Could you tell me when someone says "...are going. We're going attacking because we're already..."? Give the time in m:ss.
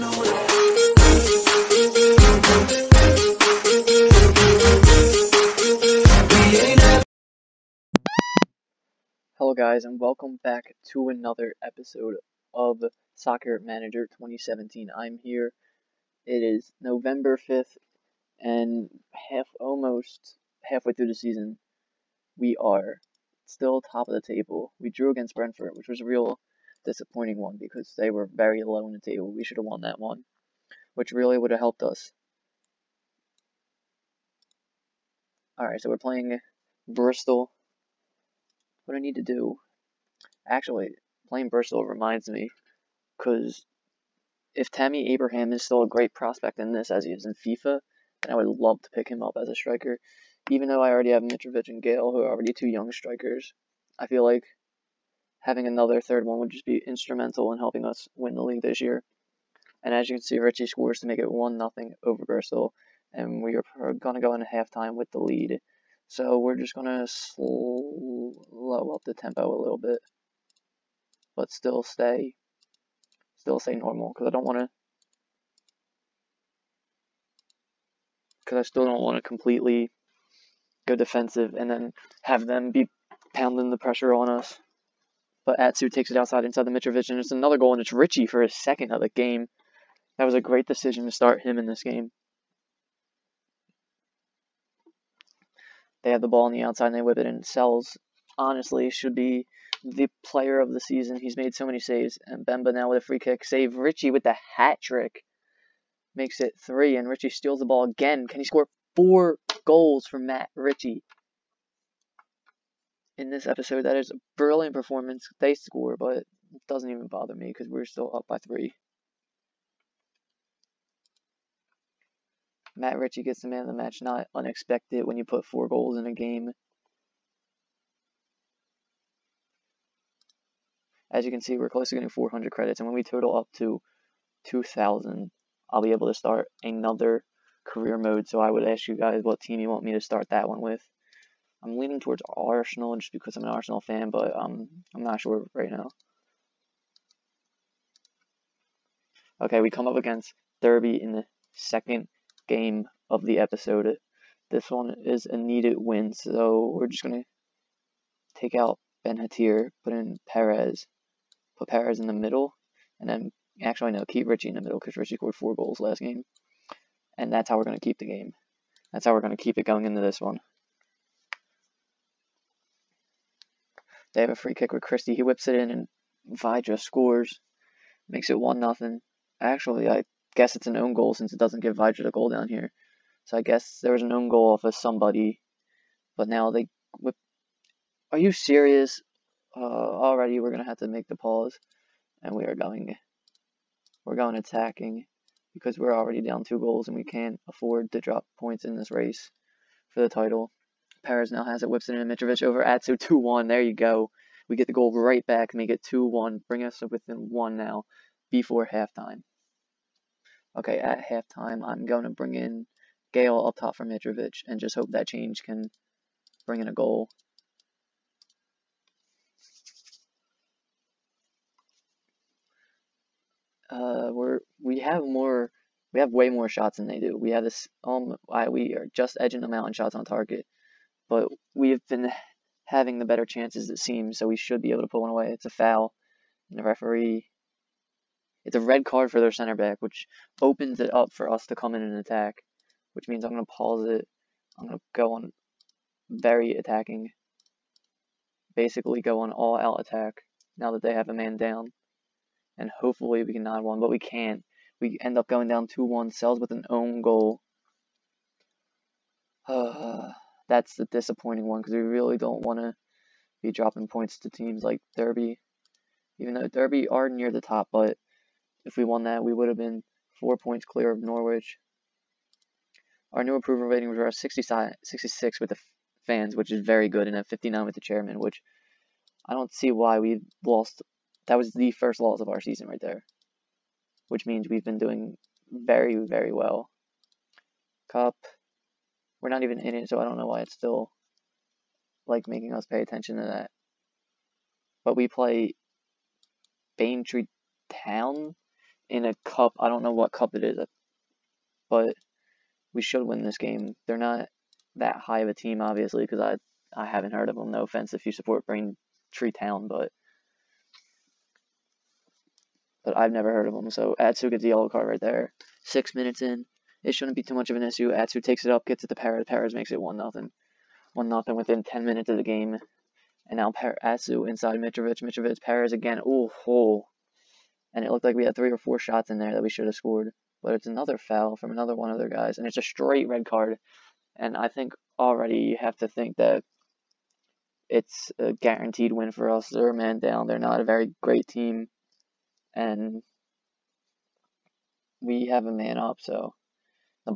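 3:12.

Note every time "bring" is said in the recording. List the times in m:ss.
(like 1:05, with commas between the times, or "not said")
3:26, 3:32, 3:36.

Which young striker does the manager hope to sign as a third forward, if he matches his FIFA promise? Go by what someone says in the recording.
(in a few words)
Tammy Abraham.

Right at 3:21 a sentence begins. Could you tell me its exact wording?
Perez now has it, whips it in, and Mitrovic over Atsu 2 1.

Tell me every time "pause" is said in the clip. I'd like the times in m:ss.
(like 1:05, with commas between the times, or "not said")
3:11, 4:03.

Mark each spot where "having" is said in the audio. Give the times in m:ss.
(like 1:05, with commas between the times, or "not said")
0:55, 3:52.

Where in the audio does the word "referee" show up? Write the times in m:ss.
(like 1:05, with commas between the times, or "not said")
3:56.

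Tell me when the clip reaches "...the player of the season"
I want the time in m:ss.
1:39.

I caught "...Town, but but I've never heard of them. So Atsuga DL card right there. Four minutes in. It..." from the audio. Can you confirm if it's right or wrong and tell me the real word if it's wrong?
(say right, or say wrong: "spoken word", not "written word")
wrong: "Six", not "Four".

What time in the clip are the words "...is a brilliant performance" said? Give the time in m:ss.
1:53.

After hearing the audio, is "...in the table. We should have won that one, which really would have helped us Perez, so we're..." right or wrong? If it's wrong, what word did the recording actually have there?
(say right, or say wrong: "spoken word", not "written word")
wrong: "Alright", not "Perez".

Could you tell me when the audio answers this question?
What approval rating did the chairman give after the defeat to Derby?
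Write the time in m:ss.
4:37.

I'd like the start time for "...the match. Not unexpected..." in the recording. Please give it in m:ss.
2:03.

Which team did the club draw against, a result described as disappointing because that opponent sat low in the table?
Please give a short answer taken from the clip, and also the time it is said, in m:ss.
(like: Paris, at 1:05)
Brentford, at 0:25.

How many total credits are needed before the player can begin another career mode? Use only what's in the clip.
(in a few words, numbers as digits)
2,000.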